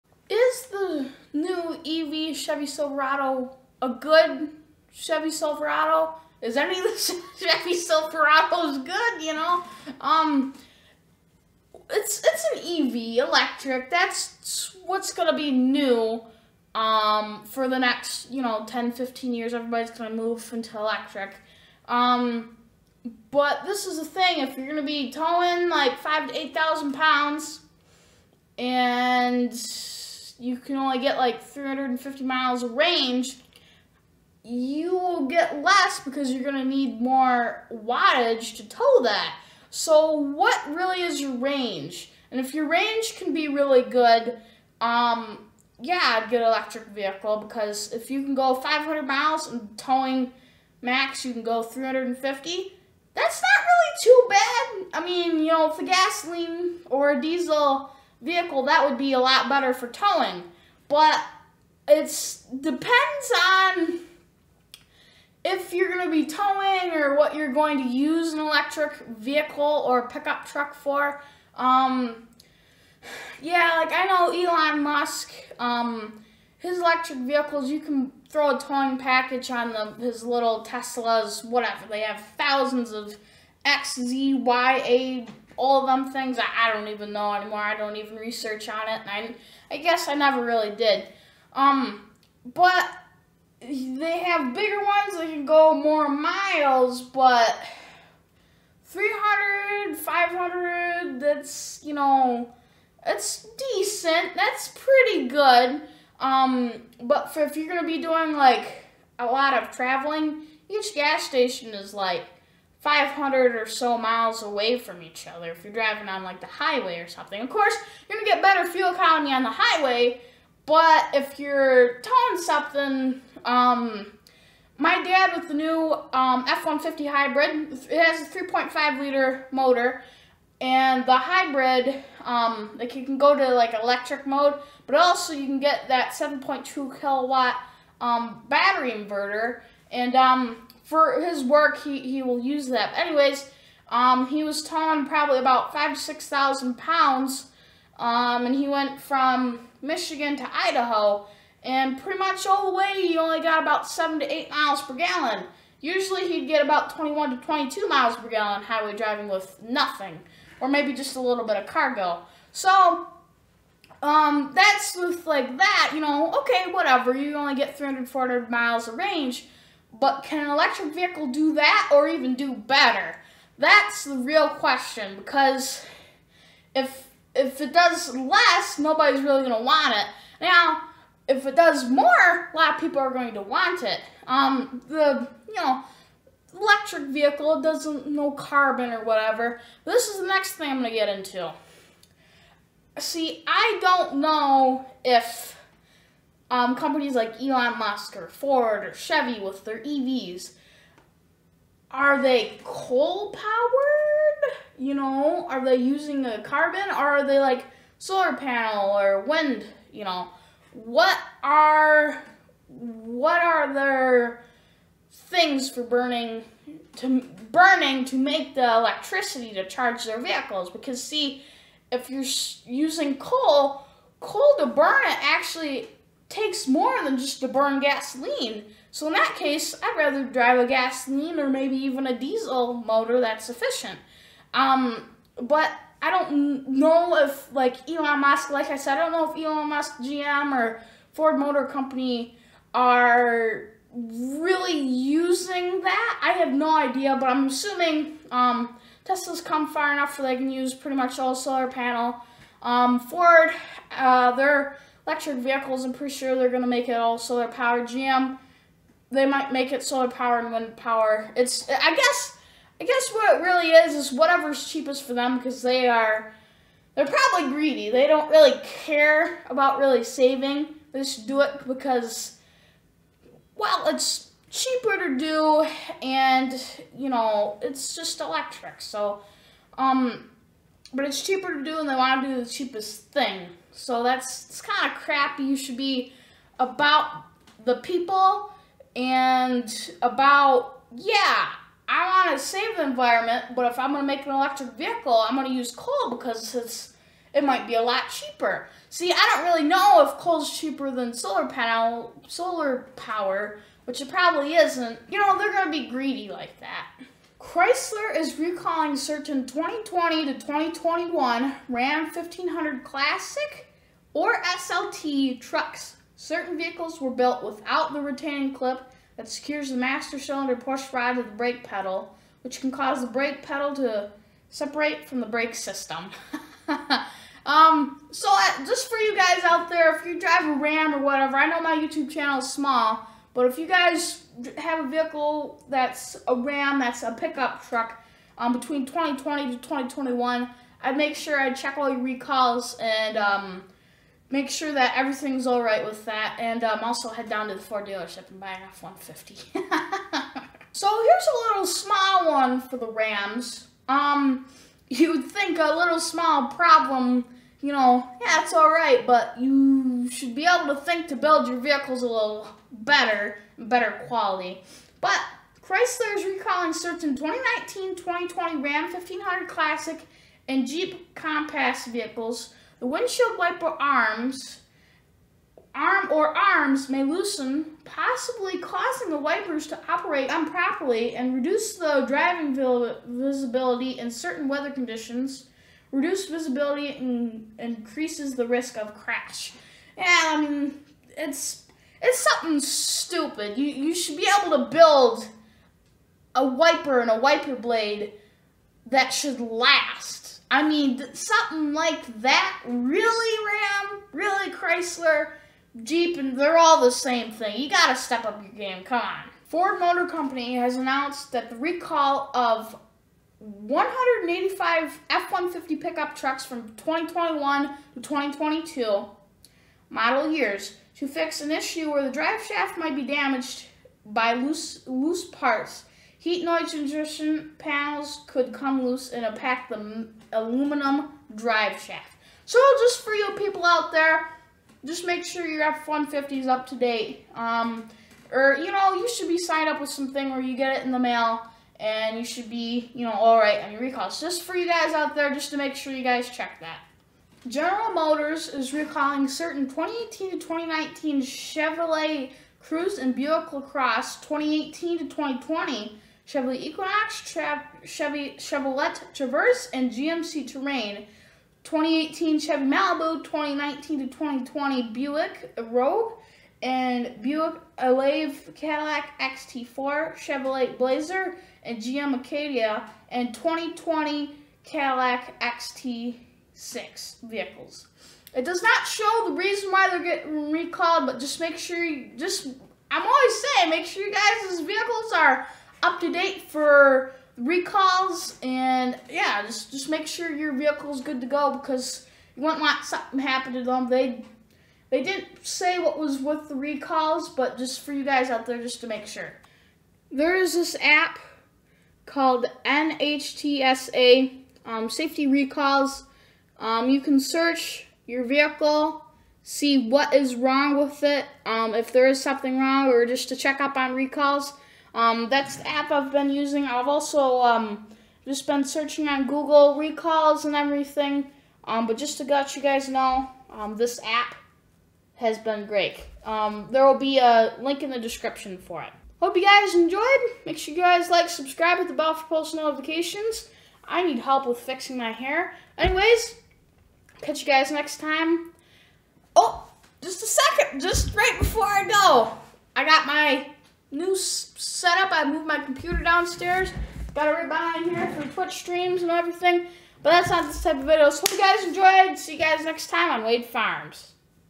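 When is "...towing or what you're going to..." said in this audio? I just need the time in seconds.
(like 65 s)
66 s.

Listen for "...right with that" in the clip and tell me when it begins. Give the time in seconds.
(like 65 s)
345 s.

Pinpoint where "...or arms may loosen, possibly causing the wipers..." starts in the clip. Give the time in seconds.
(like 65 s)
376 s.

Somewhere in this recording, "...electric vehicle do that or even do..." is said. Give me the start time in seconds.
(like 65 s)
170 s.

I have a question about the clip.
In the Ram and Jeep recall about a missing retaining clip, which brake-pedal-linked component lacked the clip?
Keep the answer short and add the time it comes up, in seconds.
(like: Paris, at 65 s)
master cylinder push rod, at 319 s.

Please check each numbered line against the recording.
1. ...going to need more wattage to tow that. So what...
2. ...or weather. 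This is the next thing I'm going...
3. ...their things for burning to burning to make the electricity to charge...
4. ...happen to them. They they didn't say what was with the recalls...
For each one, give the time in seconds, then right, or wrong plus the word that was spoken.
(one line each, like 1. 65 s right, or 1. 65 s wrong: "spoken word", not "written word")
1. 36 s right
2. 188 s wrong: "whatever", not "weather"
3. 213 s right
4. 493 s right.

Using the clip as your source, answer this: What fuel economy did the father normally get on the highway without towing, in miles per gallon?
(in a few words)
21 to 22.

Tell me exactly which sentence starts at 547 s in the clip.
Got it right behind here for Twitch streams and everything.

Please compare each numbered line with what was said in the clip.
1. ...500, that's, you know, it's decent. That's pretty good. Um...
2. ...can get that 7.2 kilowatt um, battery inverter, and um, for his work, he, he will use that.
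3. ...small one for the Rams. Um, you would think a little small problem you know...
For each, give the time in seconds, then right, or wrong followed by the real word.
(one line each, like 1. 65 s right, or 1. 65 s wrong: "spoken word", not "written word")
1. 99 s right
2. 135 s right
3. 351 s right.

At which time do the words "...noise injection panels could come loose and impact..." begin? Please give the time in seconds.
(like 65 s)
426 s.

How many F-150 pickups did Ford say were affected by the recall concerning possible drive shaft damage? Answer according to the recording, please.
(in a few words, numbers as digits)
185.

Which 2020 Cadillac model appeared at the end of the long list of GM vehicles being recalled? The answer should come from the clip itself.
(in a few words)
Cadillac XT6.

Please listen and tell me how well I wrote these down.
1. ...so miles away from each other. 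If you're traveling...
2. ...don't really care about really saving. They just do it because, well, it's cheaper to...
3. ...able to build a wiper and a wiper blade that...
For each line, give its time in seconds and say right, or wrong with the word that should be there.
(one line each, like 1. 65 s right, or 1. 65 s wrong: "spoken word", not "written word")
1. 113 s wrong: "driving", not "traveling"
2. 268 s right
3. 394 s right.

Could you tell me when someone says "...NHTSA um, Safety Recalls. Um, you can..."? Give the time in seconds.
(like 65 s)
502 s.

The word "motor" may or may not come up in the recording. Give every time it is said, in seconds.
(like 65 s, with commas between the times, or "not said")
129 s, 232 s, 241 s, 409 s, 447 s.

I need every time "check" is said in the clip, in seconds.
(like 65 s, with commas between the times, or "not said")
341 s, 446 s, 513 s.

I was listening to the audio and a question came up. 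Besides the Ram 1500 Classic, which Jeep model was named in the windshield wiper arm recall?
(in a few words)
Jeep Compass.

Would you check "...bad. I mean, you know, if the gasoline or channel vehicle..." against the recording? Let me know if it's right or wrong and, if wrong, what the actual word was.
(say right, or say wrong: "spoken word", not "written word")
wrong: "diesel", not "channel".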